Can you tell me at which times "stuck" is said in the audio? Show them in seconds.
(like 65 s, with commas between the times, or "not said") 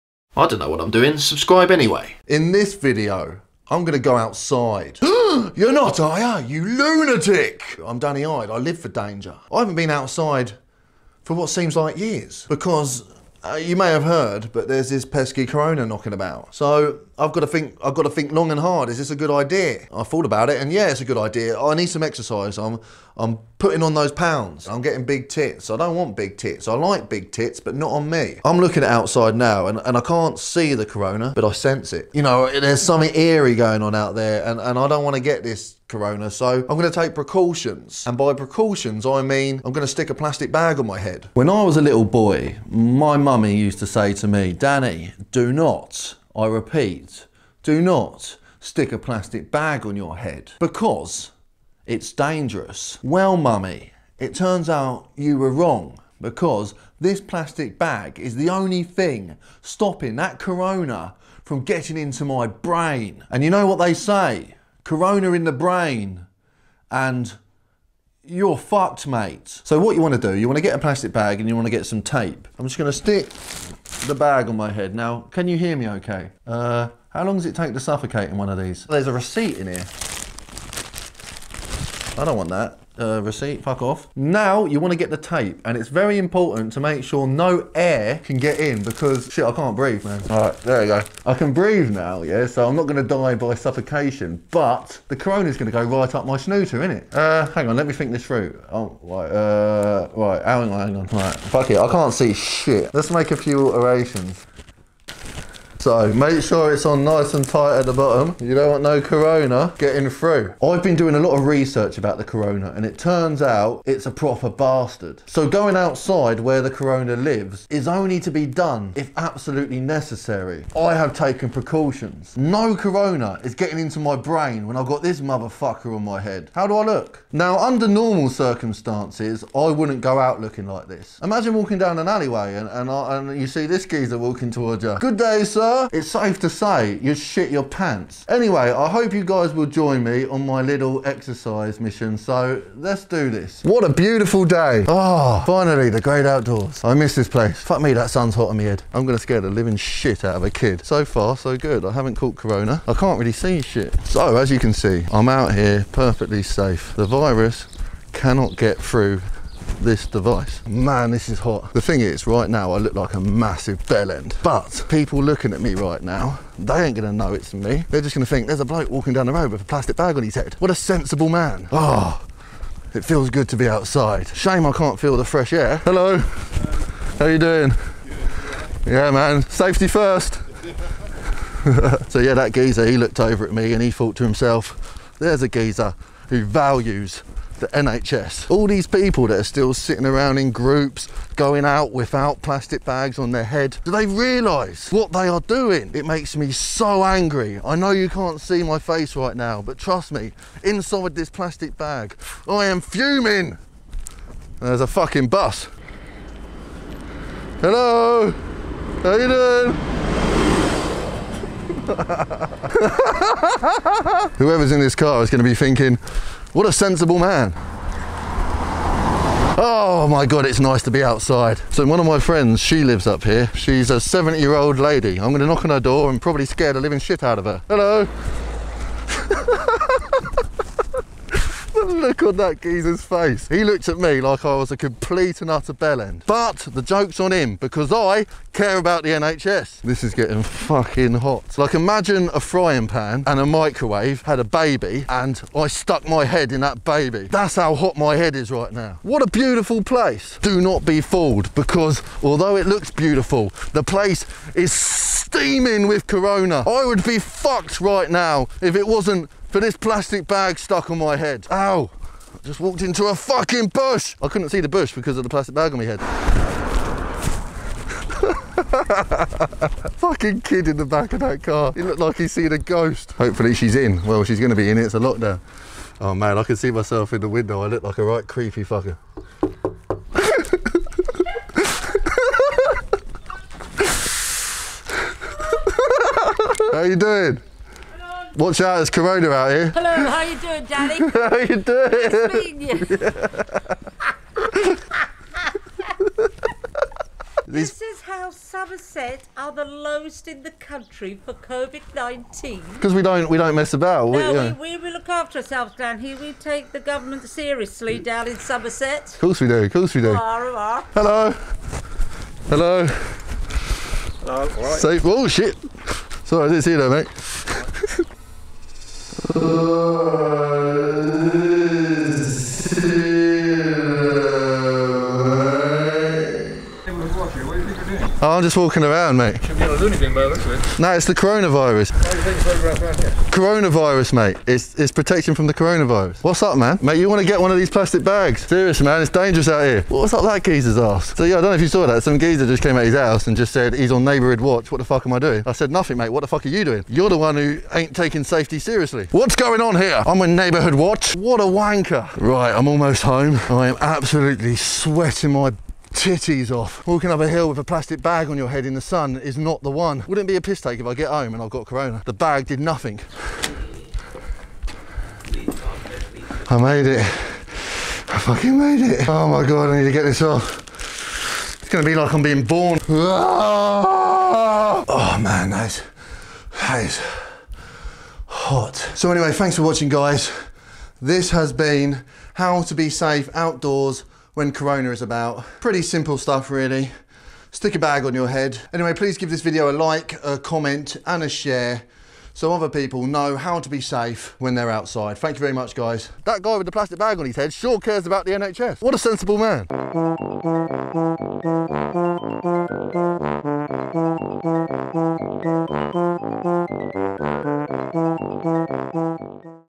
245 s, 260 s.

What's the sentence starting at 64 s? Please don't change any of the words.
corona in the brain, and you're fucked, mate.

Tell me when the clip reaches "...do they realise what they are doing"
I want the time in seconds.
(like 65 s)
193 s.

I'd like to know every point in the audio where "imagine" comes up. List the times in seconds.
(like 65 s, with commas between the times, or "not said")
131 s, 241 s.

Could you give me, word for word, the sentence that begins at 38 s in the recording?
And by precautions, I mean I'm going to stick a plastic bag on my head.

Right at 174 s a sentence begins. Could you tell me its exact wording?
Shame I can't feel the fresh air.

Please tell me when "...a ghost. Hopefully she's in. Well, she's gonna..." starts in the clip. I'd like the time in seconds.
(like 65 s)
272 s.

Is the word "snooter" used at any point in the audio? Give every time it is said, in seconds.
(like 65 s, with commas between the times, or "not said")
96 s.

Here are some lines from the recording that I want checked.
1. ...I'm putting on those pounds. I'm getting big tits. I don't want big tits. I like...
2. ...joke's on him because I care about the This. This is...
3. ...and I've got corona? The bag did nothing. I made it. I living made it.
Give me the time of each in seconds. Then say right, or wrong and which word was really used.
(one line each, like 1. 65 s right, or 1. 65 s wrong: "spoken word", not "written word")
1. 23 s right
2. 236 s wrong: "NHS", not "This"
3. 361 s wrong: "fucking", not "living".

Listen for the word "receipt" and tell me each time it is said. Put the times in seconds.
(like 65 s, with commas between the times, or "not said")
79 s, 83 s.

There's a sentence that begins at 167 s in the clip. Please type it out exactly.
They're just gonna think there's a bloke walking down the road with a plastic bag on his head.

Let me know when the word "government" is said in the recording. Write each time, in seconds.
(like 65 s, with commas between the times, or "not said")
306 s.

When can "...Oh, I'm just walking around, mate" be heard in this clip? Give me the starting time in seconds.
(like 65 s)
328 s.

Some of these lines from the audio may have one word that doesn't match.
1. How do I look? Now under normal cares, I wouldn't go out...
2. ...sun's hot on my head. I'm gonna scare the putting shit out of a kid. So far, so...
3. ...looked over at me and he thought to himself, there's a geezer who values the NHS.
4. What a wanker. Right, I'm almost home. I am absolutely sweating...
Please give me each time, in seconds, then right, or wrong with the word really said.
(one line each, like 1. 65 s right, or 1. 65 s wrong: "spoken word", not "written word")
1. 126 s wrong: "circumstances", not "cares"
2. 148 s wrong: "living", not "putting"
3. 182 s right
4. 351 s right.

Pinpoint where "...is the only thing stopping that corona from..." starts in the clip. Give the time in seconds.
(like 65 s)
58 s.